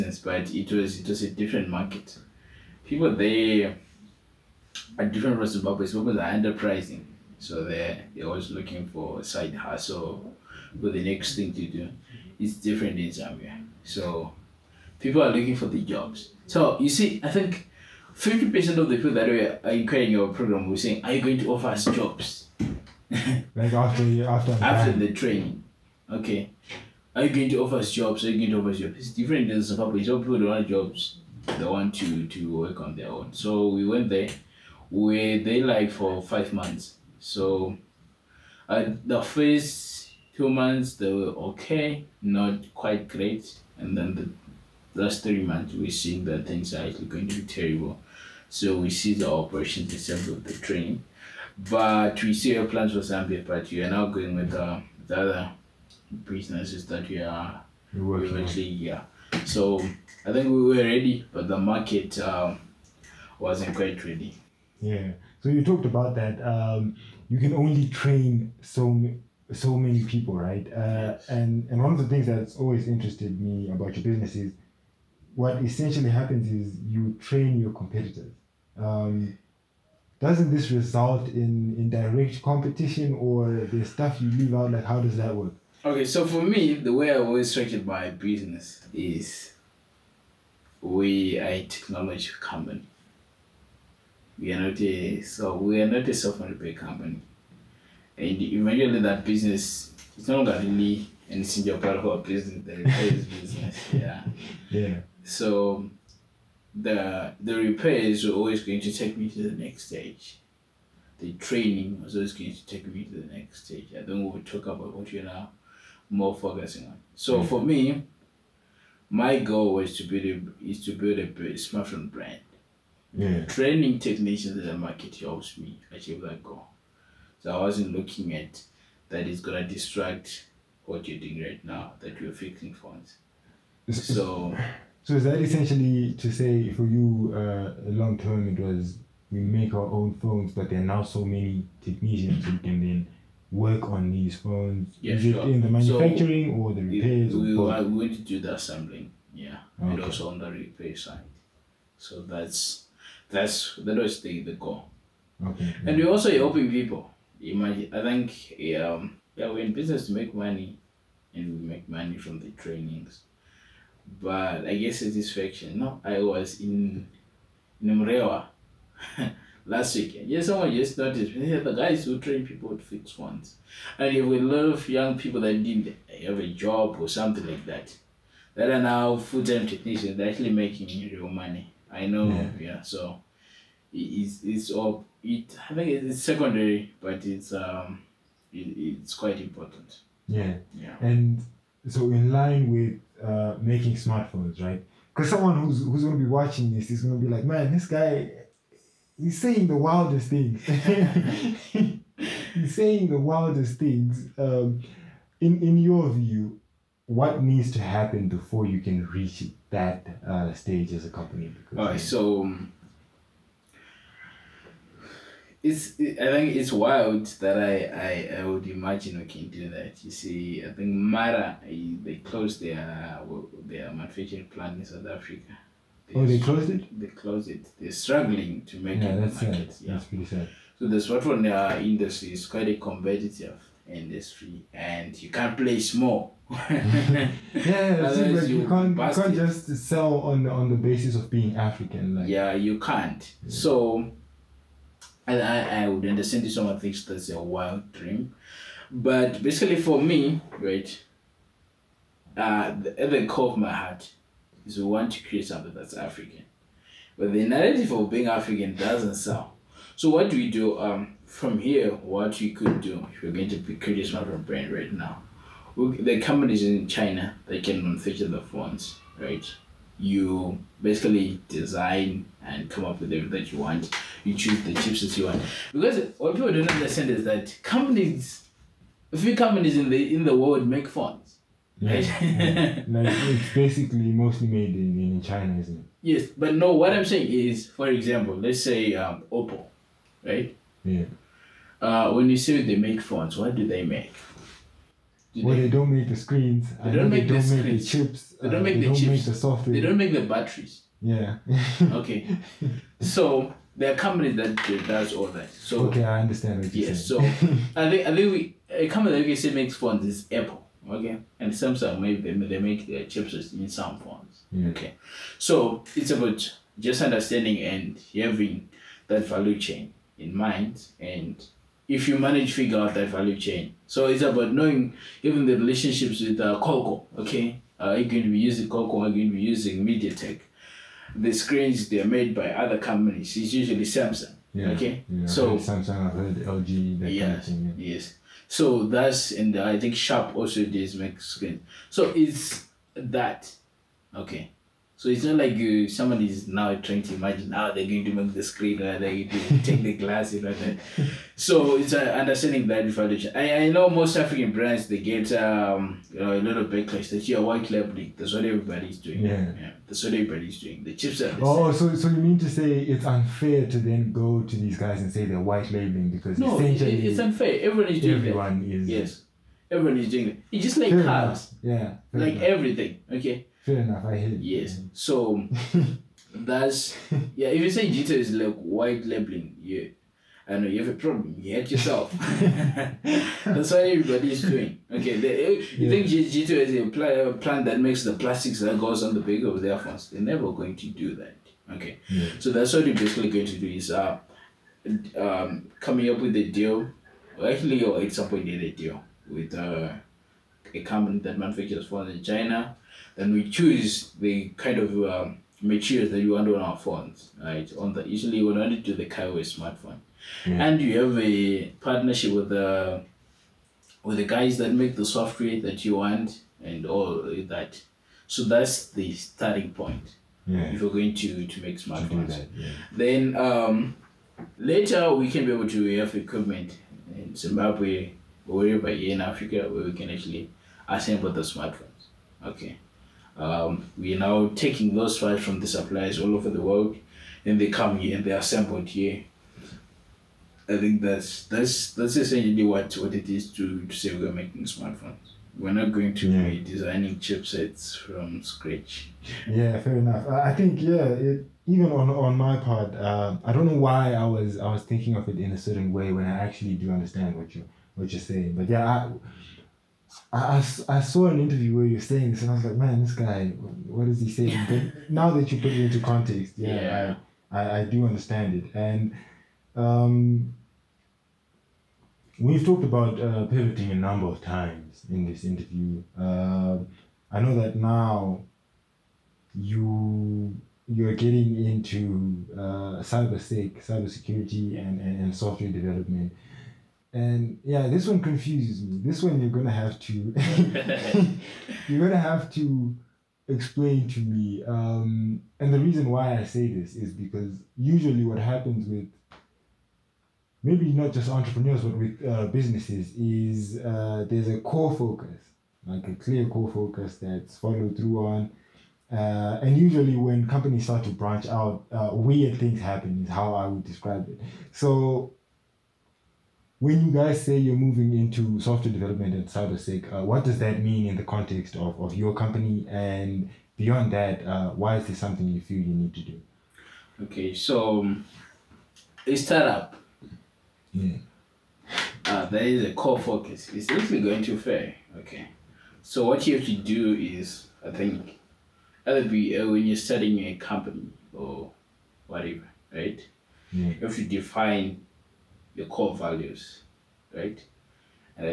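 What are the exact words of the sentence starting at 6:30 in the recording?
They're never going to do that.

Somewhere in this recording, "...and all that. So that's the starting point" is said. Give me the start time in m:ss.
6:56.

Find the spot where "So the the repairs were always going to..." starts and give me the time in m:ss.
1:45.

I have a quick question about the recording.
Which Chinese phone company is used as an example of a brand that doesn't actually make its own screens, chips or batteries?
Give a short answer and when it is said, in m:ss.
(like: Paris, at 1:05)
Oppo, at 4:49.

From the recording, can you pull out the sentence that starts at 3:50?
So the smartphone uh, industry is quite a competitive industry, and you can't play small.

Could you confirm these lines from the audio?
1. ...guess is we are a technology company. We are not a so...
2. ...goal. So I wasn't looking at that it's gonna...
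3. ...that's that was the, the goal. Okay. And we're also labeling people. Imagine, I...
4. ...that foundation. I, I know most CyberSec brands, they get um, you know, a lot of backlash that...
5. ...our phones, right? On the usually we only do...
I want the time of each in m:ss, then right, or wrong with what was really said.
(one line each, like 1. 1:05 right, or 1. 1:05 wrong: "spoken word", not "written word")
1. 1:28 wrong: "business", not "guess"
2. 2:06 right
3. 2:33 wrong: "helping", not "labeling"
4. 5:52 wrong: "African", not "CyberSec"
5. 6:46 right.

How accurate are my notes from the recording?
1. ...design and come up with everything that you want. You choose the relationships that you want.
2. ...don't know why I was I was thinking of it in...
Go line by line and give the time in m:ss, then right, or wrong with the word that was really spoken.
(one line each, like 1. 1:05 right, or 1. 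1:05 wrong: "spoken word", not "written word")
1. 4:31 wrong: "chips", not "relationships"
2. 7:33 right.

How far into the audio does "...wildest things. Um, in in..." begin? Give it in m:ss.
3:23.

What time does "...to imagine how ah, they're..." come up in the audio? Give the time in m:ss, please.
5:47.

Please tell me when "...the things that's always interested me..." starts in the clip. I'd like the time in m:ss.
1:11.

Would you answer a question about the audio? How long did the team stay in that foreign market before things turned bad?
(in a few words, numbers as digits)
5 months.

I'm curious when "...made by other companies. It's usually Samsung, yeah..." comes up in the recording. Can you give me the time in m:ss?
5:32.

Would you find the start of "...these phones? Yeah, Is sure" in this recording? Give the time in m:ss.
2:24.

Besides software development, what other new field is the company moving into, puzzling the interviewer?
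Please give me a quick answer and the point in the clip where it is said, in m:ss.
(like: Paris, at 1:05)
Cyber security, at 8:03.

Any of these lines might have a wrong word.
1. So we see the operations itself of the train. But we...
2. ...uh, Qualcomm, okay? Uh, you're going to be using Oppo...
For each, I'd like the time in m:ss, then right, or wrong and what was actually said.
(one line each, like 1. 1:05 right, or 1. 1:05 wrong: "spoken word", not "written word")
1. 0:48 right
2. 5:26 wrong: "Qualcomm", not "Oppo".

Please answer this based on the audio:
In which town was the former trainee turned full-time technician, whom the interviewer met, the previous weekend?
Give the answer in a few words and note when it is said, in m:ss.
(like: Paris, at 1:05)
Mrewa, at 2:47.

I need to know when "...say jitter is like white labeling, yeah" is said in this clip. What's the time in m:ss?
6:17.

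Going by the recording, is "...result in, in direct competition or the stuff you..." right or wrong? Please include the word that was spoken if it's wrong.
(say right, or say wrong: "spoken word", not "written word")
right.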